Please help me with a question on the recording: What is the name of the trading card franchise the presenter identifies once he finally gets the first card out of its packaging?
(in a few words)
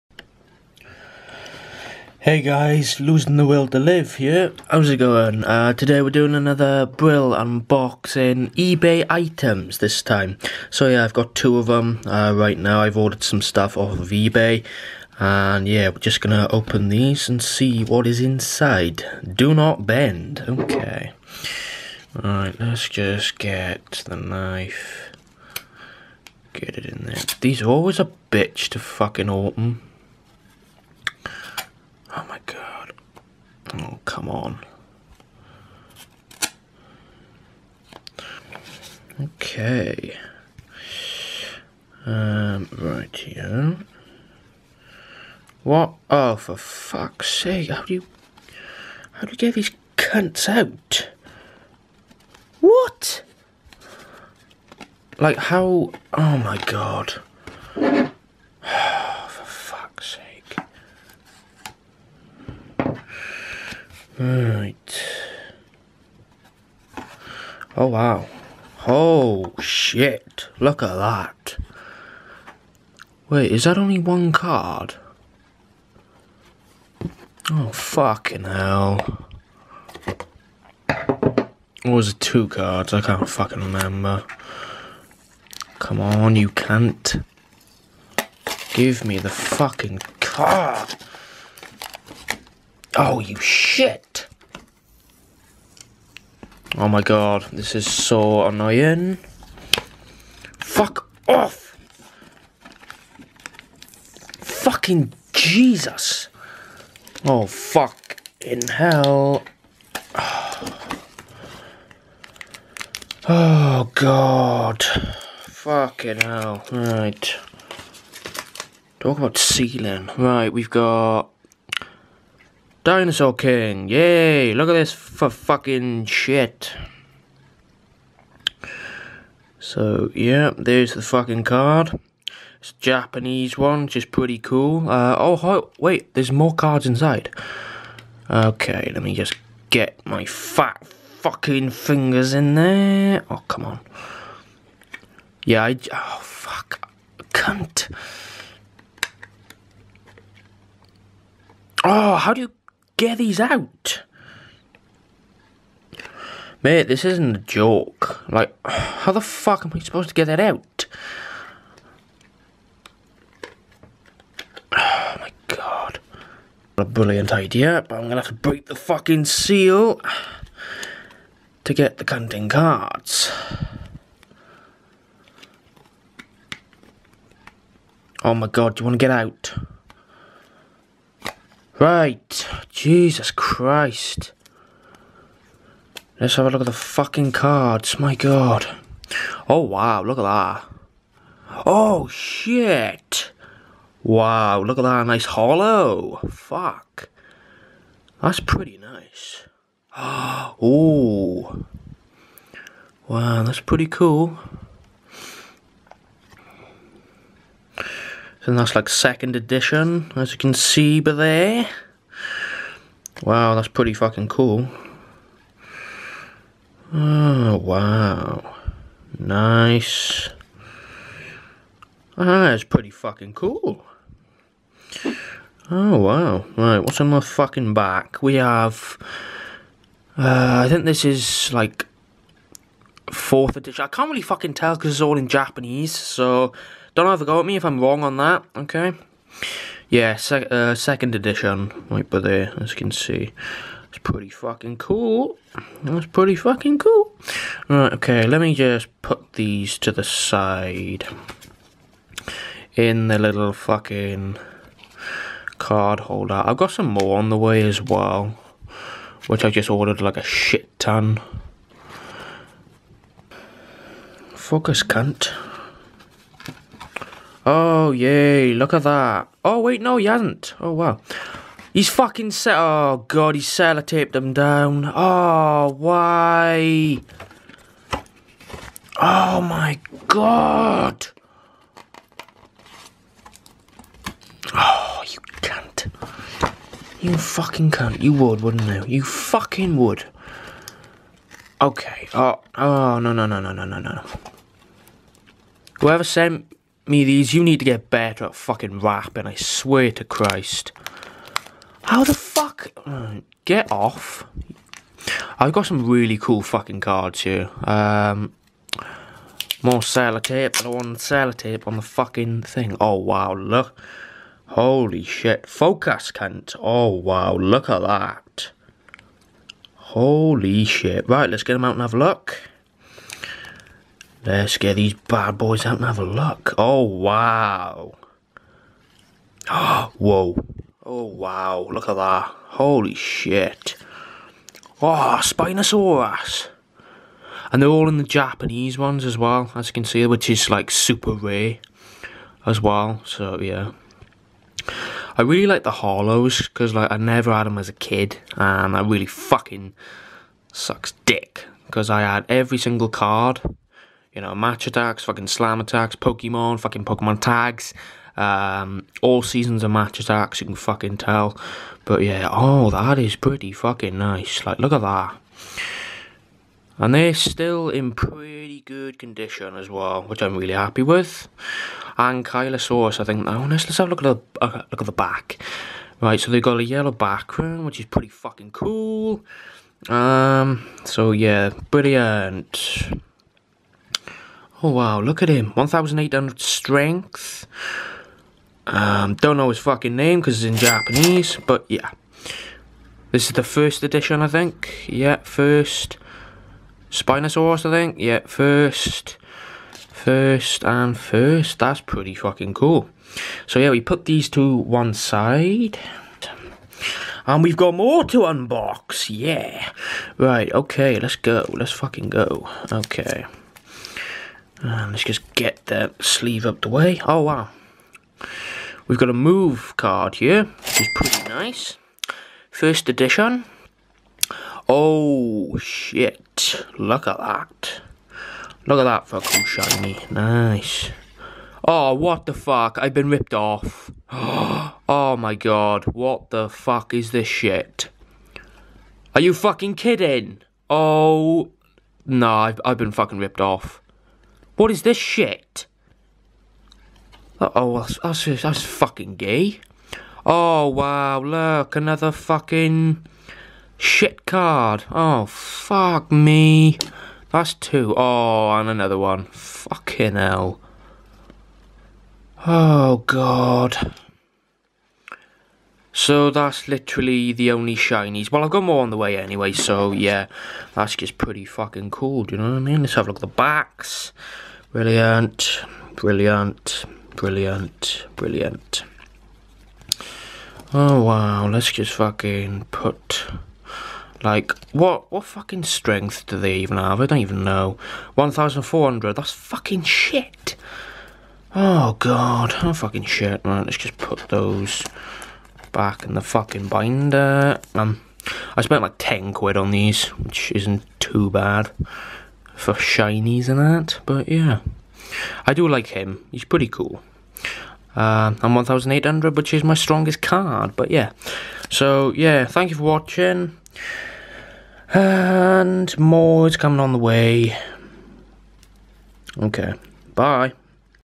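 Dinosaur King.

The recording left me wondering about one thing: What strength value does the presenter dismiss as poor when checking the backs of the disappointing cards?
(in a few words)
1,400.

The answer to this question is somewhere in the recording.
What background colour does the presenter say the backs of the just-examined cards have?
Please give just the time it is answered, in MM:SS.
06:16.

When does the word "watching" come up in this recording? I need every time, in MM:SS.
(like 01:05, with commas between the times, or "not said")
08:32.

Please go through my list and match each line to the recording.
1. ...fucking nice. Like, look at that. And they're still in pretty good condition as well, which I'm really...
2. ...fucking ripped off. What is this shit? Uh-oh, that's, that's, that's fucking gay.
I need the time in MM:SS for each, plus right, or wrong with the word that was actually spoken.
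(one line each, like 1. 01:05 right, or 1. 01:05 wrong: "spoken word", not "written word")
1. 06:03 right
2. 07:22 right.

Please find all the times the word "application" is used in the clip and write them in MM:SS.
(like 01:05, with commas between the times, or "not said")
not said.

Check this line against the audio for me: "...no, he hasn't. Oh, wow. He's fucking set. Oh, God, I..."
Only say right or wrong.
right.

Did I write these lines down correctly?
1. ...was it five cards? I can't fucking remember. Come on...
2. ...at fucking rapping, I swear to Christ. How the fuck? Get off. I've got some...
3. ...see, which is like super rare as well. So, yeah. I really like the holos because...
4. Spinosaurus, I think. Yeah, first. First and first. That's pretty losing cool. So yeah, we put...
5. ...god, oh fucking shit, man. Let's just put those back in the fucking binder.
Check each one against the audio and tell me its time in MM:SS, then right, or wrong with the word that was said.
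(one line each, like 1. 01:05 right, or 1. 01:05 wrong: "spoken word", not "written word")
1. 01:21 wrong: "two", not "five"
2. 04:58 right
3. 05:39 right
4. 06:36 wrong: "fucking", not "losing"
5. 08:11 right.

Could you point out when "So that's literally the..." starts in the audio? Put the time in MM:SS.
07:46.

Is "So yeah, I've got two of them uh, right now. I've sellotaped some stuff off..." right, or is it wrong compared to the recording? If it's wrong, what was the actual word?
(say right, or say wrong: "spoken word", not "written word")
wrong: "ordered", not "sellotaped".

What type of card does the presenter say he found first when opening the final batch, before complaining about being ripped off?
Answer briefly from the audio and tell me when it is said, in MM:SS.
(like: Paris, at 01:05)
A move card, at 06:59.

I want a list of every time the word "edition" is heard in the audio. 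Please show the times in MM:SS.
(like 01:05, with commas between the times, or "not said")
03:29, 03:53, 04:01, 06:33, 07:02.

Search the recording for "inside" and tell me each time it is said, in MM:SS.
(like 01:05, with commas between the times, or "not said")
00:18, 02:16.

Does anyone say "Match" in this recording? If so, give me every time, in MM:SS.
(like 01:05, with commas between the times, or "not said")
05:54, 05:59.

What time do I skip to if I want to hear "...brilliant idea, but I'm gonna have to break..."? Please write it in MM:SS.
02:46.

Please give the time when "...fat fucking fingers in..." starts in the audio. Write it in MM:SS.
02:20.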